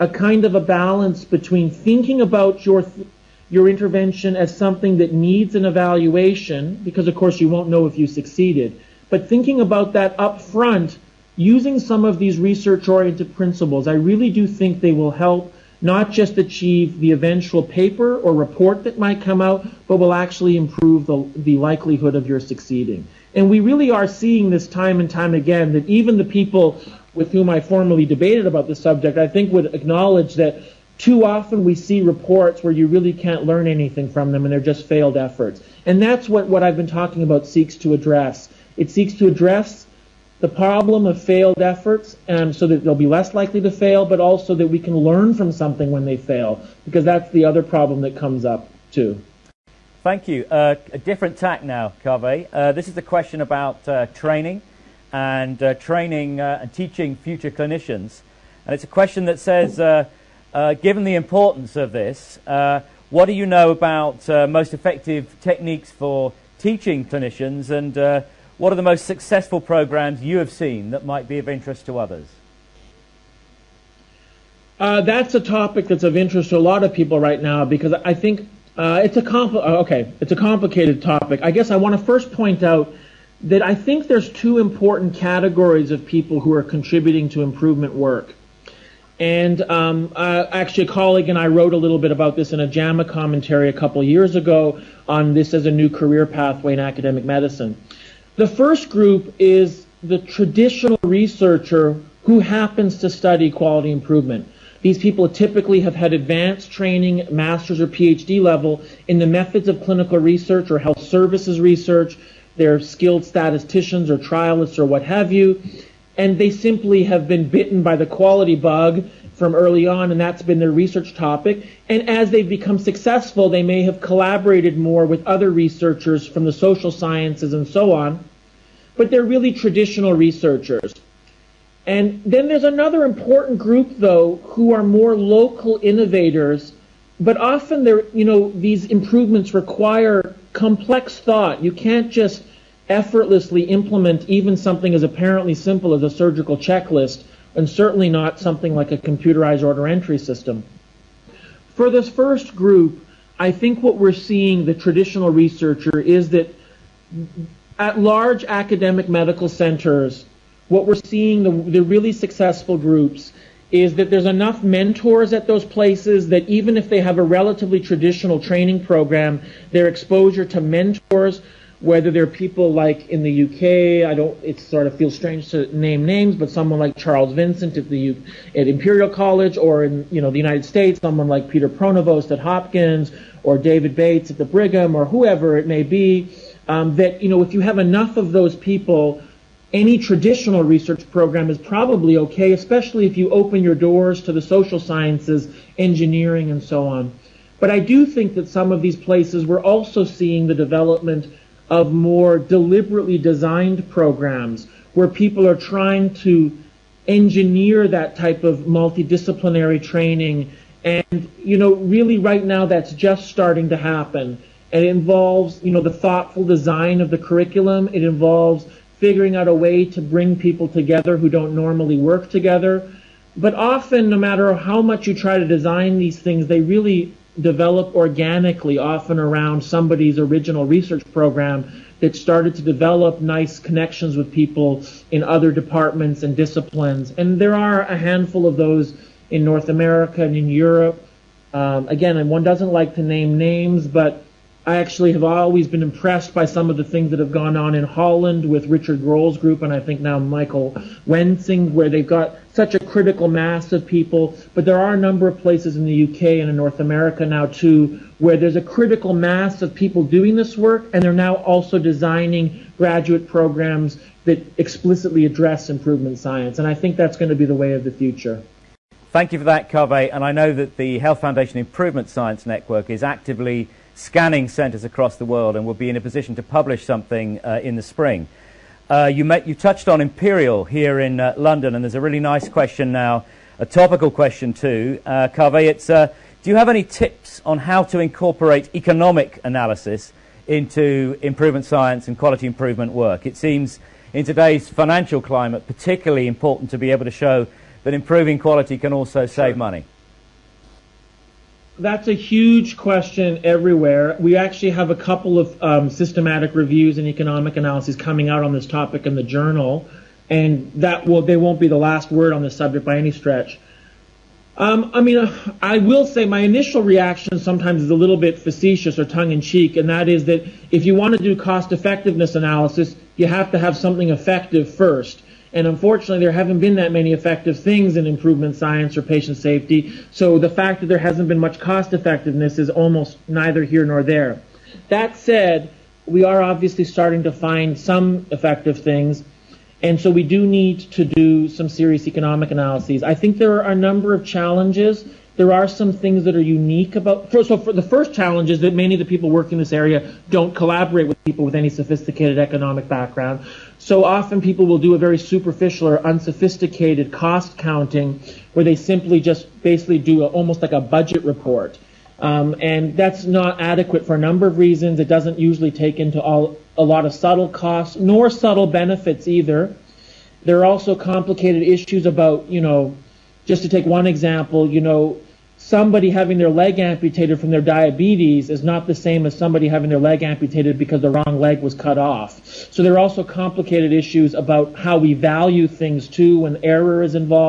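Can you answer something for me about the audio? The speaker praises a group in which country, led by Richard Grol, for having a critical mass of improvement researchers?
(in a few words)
Holland.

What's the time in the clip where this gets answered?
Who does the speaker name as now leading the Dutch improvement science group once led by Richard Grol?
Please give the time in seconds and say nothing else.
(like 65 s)
250 s.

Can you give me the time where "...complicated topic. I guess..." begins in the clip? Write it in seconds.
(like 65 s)
80 s.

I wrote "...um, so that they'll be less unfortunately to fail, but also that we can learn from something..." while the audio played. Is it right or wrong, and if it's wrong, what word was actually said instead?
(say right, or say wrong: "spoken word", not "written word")
wrong: "likely", not "unfortunately".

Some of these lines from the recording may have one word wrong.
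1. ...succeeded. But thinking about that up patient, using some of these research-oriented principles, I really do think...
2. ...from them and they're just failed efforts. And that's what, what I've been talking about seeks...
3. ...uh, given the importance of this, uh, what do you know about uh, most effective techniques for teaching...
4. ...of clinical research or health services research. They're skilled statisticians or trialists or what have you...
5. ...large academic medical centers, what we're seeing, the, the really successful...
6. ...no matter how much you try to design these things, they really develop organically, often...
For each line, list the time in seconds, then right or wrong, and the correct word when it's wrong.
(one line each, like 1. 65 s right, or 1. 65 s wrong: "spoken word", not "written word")
1. 8 s wrong: "front", not "patient"
2. 34 s right
3. 60 s right
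4. 109 s right
5. 157 s right
6. 224 s right.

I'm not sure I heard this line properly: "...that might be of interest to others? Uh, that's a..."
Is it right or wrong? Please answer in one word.
right.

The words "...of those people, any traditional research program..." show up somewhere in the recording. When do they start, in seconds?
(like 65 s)
188 s.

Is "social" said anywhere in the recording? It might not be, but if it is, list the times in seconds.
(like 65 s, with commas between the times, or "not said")
126 s, 194 s.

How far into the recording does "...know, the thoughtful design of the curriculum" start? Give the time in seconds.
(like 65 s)
215 s.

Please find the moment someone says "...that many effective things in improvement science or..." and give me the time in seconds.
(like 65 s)
326 s.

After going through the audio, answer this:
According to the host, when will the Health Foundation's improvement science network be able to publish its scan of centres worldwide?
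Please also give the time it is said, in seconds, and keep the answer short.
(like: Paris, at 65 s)
in the spring, at 277 s.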